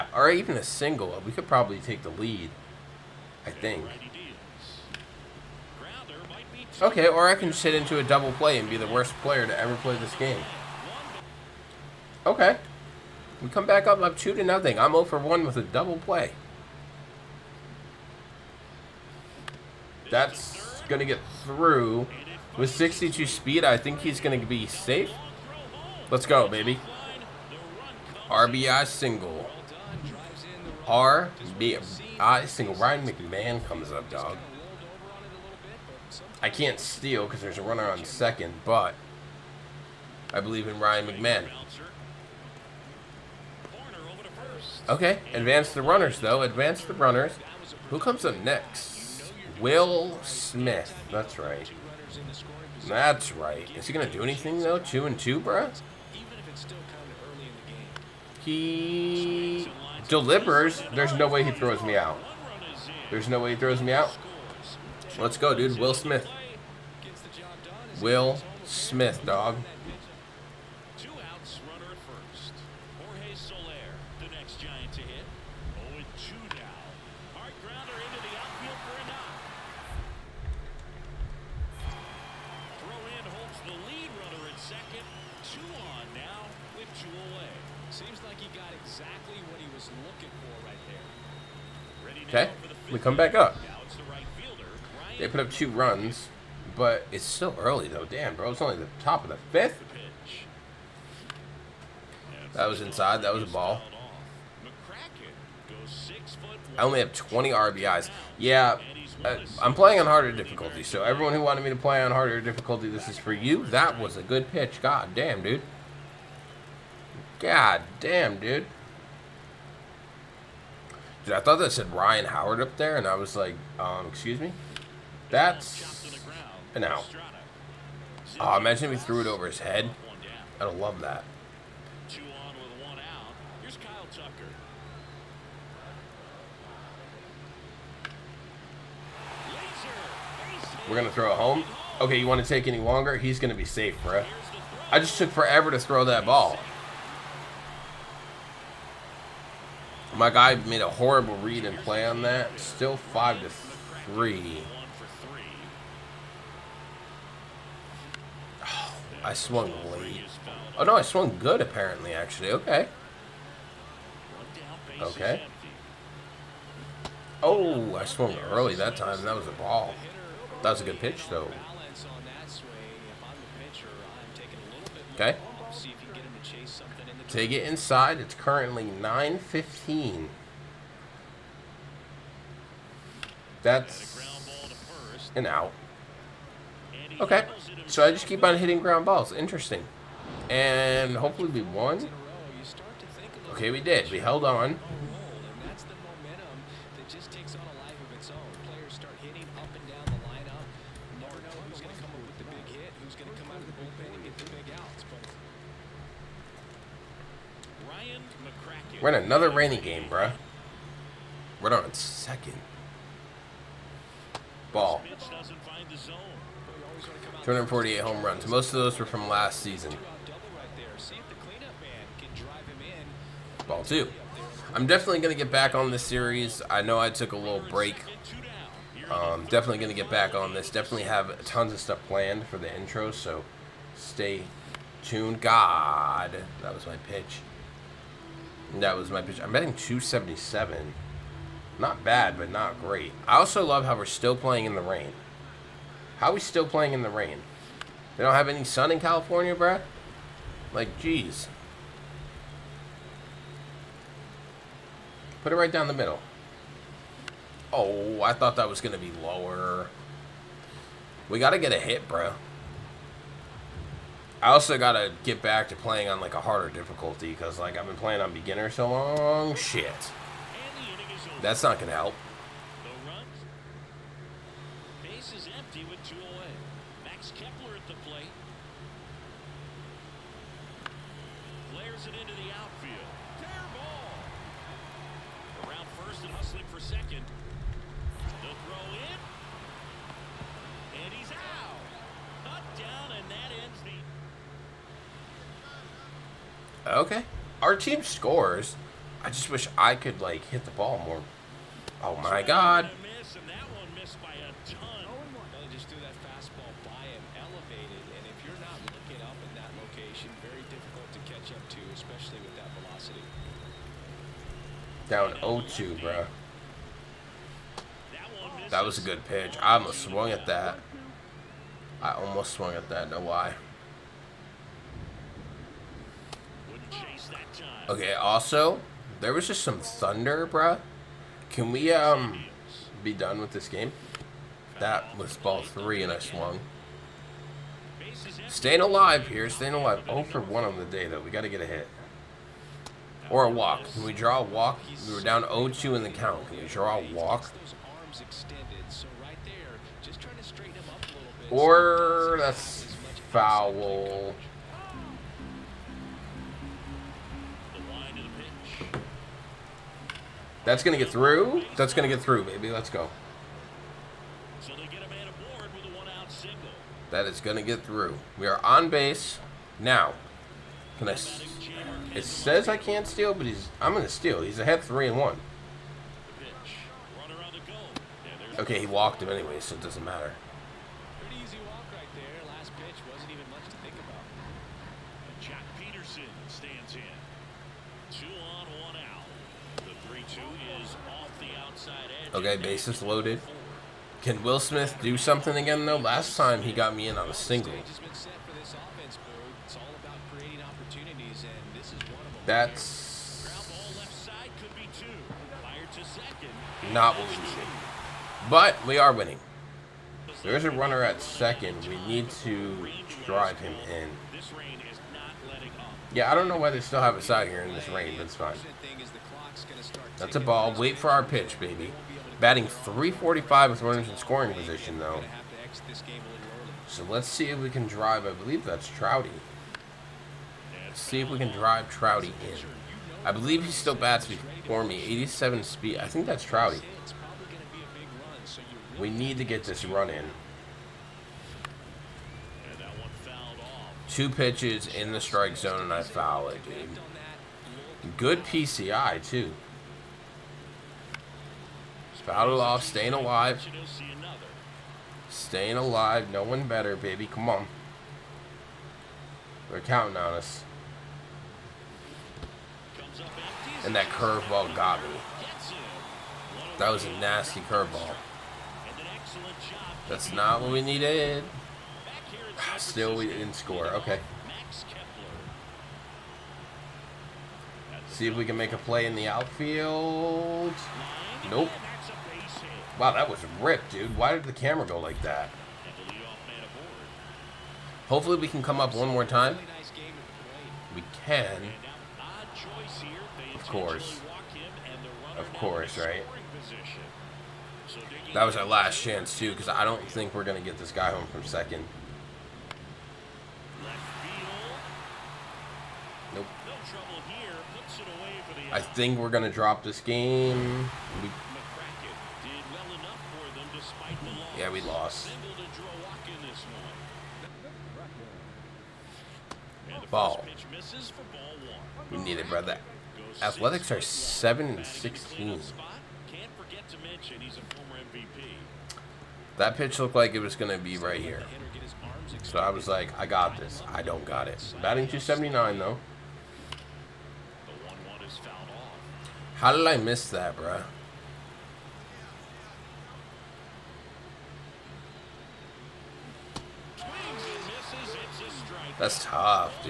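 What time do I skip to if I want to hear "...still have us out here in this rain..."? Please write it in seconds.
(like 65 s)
416 s.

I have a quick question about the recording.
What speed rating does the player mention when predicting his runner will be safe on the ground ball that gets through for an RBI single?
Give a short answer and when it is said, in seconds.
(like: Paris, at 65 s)
62, at 22 s.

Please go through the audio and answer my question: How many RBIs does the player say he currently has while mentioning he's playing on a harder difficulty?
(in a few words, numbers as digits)
20.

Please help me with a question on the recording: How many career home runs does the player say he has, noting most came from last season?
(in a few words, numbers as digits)
248.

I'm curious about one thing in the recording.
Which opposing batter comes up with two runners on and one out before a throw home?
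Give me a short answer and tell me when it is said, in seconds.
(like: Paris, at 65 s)
Kyle Tucker, at 133 s.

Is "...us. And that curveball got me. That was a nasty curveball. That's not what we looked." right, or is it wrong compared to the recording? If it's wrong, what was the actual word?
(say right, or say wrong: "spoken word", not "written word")
wrong: "needed", not "looked".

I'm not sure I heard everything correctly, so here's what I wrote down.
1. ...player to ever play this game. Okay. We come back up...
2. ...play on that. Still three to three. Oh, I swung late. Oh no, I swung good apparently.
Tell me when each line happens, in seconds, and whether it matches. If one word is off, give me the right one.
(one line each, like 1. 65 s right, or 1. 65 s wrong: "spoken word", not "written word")
1. 9 s right
2. 151 s wrong: "five", not "three".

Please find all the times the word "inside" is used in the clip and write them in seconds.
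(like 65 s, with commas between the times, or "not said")
102 s, 177 s.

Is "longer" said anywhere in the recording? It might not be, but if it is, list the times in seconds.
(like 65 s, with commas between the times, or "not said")
142 s.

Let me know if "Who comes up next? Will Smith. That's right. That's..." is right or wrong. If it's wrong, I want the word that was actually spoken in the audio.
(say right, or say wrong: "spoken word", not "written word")
right.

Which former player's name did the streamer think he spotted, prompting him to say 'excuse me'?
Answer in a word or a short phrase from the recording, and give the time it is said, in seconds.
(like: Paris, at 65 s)
Ryan Howard, at 121 s.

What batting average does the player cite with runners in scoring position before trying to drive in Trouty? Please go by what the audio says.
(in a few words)
345.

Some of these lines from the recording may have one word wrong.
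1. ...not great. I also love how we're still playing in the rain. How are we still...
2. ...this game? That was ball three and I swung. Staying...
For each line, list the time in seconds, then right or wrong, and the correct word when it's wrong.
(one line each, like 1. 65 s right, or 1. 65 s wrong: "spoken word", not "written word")
1. 242 s right
2. 333 s right.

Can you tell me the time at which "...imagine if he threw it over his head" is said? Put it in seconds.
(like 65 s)
128 s.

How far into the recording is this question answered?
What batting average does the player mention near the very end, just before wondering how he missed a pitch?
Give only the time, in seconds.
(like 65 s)
535 s.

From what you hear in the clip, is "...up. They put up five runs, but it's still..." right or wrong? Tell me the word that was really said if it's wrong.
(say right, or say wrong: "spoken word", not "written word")
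wrong: "two", not "five".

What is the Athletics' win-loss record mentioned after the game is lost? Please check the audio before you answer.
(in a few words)
7 and 16.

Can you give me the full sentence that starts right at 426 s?
So let's see if we can drive, I believe that's Trouty.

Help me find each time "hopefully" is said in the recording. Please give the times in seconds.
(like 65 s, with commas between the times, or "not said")
191 s, 488 s.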